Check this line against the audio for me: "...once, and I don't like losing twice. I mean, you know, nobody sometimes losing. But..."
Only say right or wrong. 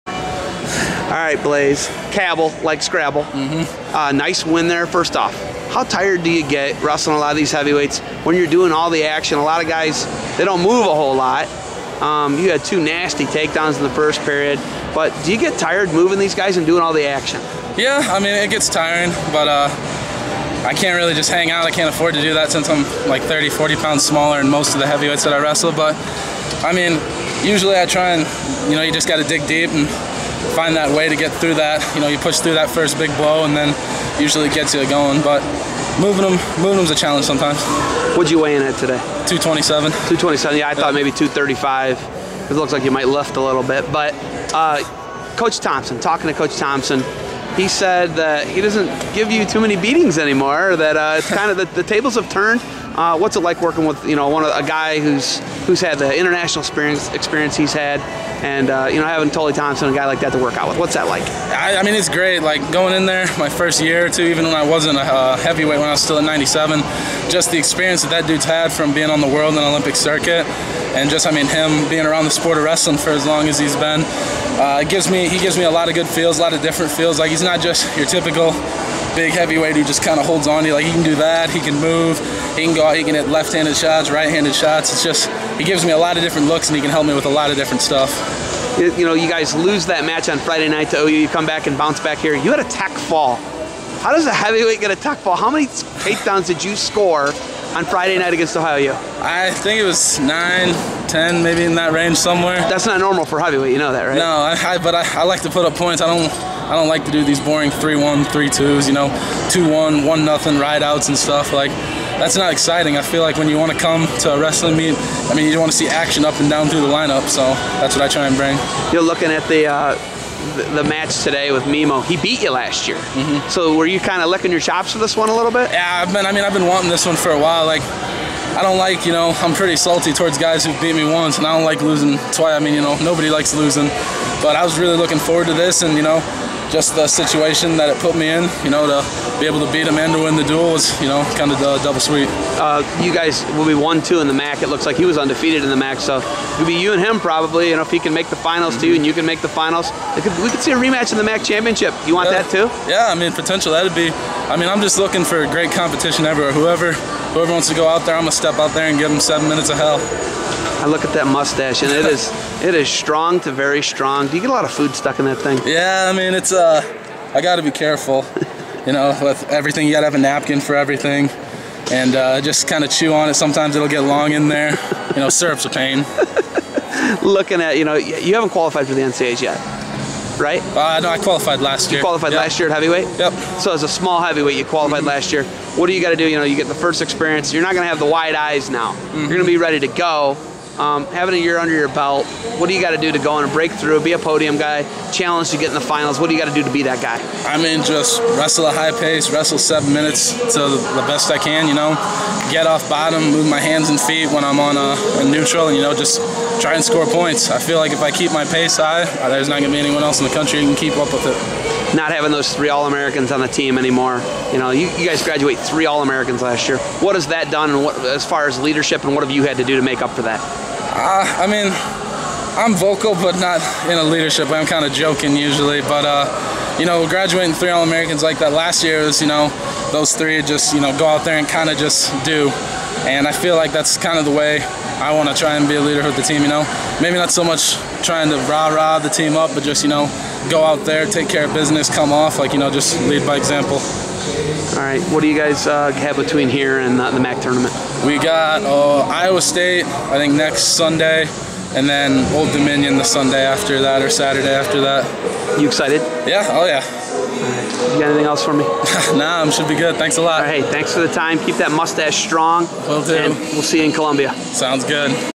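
wrong.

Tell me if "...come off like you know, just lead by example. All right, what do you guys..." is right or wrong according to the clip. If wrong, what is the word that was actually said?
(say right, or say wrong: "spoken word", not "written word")
right.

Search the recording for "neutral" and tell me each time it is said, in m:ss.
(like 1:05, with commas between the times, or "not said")
3:25.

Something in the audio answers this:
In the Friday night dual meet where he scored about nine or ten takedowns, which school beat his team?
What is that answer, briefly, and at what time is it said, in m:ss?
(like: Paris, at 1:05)
Ohio U, at 1:38.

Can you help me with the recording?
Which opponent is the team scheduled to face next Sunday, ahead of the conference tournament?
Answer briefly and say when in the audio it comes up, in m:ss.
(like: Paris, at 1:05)
Iowa State, at 4:09.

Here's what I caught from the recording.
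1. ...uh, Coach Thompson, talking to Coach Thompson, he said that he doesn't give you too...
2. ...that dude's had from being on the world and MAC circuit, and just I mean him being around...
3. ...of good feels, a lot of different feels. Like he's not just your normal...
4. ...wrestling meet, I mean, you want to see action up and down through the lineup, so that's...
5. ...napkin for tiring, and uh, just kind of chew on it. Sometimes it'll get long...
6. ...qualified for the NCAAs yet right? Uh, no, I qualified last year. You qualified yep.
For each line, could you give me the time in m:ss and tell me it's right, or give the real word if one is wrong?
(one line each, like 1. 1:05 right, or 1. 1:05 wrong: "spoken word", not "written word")
1. 0:44 right
2. 1:08 wrong: "Olympic", not "MAC"
3. 1:15 wrong: "typical", not "normal"
4. 1:54 right
5. 2:50 wrong: "everything", not "tiring"
6. 2:58 right.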